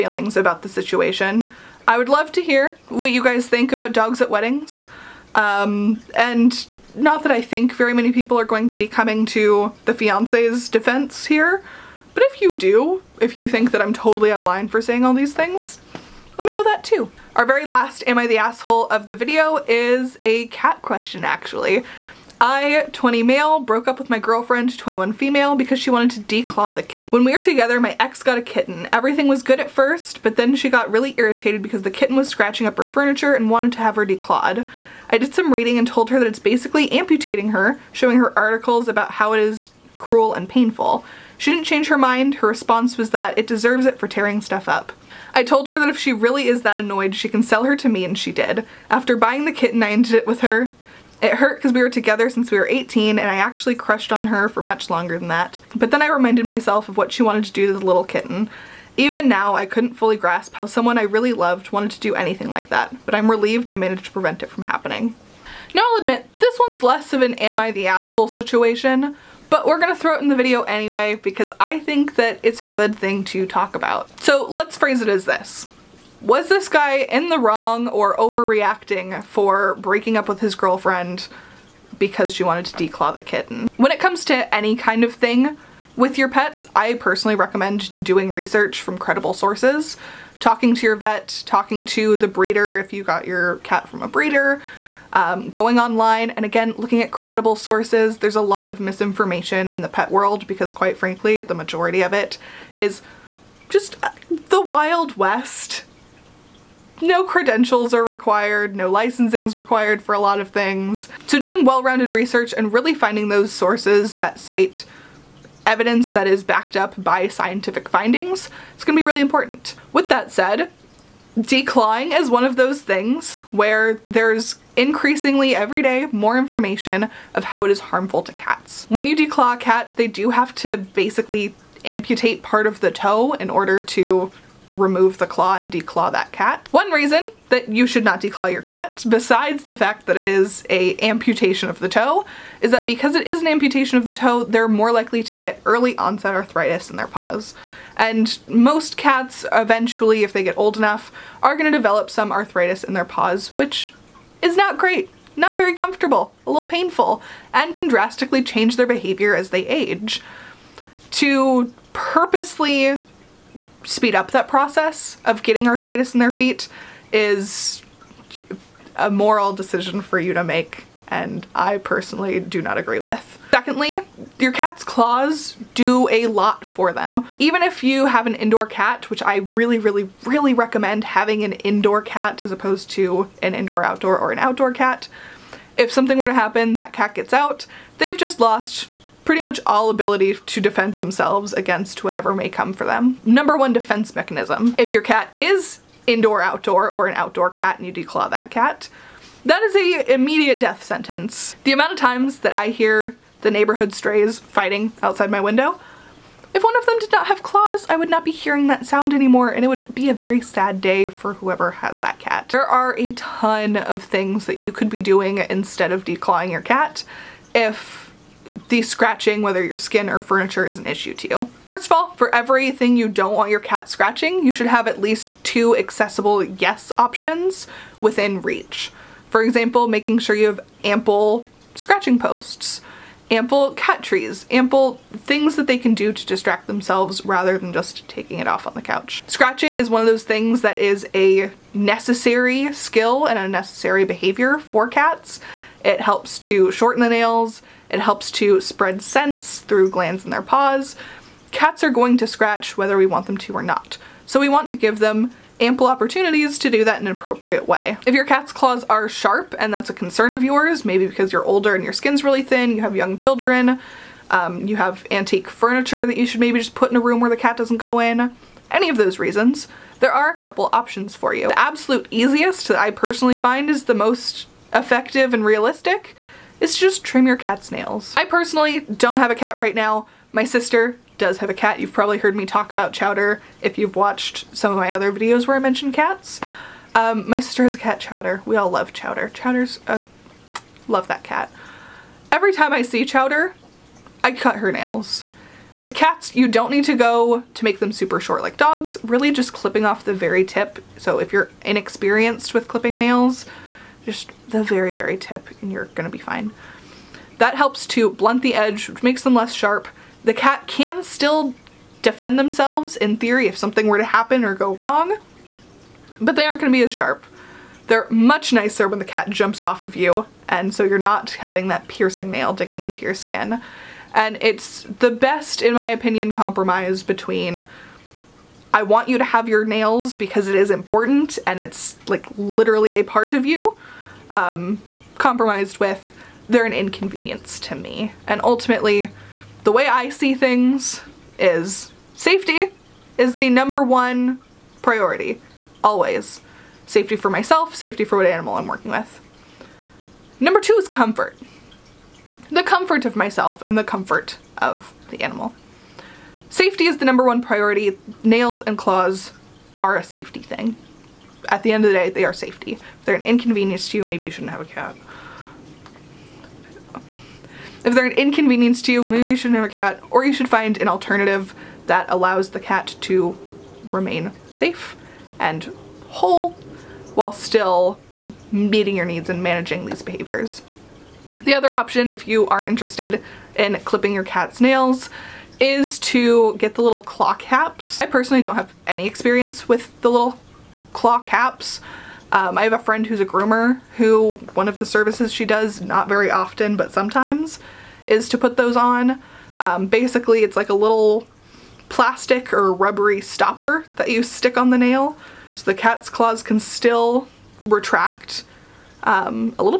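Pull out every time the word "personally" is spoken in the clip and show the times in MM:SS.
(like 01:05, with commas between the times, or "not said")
01:26, 02:51, 04:32, 04:38, 06:28.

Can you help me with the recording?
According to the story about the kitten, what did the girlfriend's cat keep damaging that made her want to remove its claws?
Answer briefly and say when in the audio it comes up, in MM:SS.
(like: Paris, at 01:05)
Her furniture, at 00:32.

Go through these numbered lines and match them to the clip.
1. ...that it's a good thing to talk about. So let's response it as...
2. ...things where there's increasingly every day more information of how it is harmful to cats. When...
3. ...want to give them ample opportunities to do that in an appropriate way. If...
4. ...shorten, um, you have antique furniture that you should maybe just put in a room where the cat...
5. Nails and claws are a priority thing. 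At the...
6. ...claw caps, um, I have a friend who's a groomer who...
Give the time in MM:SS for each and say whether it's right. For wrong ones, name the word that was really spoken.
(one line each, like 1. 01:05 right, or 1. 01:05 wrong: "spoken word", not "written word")
1. 01:12 wrong: "phrase", not "response"
2. 02:02 right
3. 04:14 right
4. 04:23 wrong: "children", not "shorten"
5. 05:58 wrong: "safety", not "priority"
6. 06:30 right.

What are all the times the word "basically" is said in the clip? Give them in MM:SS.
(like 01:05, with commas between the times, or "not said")
00:36, 02:10, 06:39.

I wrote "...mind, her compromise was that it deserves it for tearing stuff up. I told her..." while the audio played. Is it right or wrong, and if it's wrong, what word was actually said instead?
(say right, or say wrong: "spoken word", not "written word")
wrong: "response", not "compromise".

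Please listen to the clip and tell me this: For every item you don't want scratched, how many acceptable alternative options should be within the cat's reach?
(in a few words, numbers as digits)
2.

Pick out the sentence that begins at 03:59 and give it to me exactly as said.
Scratching is one of those things that is a necessary skill and a necessary behavior for cats.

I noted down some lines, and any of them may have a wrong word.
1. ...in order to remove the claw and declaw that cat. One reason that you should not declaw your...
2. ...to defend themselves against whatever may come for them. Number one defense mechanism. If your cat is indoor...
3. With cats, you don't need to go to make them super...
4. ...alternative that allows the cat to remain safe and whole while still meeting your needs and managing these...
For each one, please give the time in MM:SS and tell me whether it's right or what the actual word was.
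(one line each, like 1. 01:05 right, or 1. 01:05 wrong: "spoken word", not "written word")
1. 02:13 right
2. 03:10 right
3. 04:55 right
4. 06:10 right.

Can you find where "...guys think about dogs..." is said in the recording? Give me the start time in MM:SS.
00:03.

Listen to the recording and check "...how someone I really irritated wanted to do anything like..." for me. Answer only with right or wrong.
wrong.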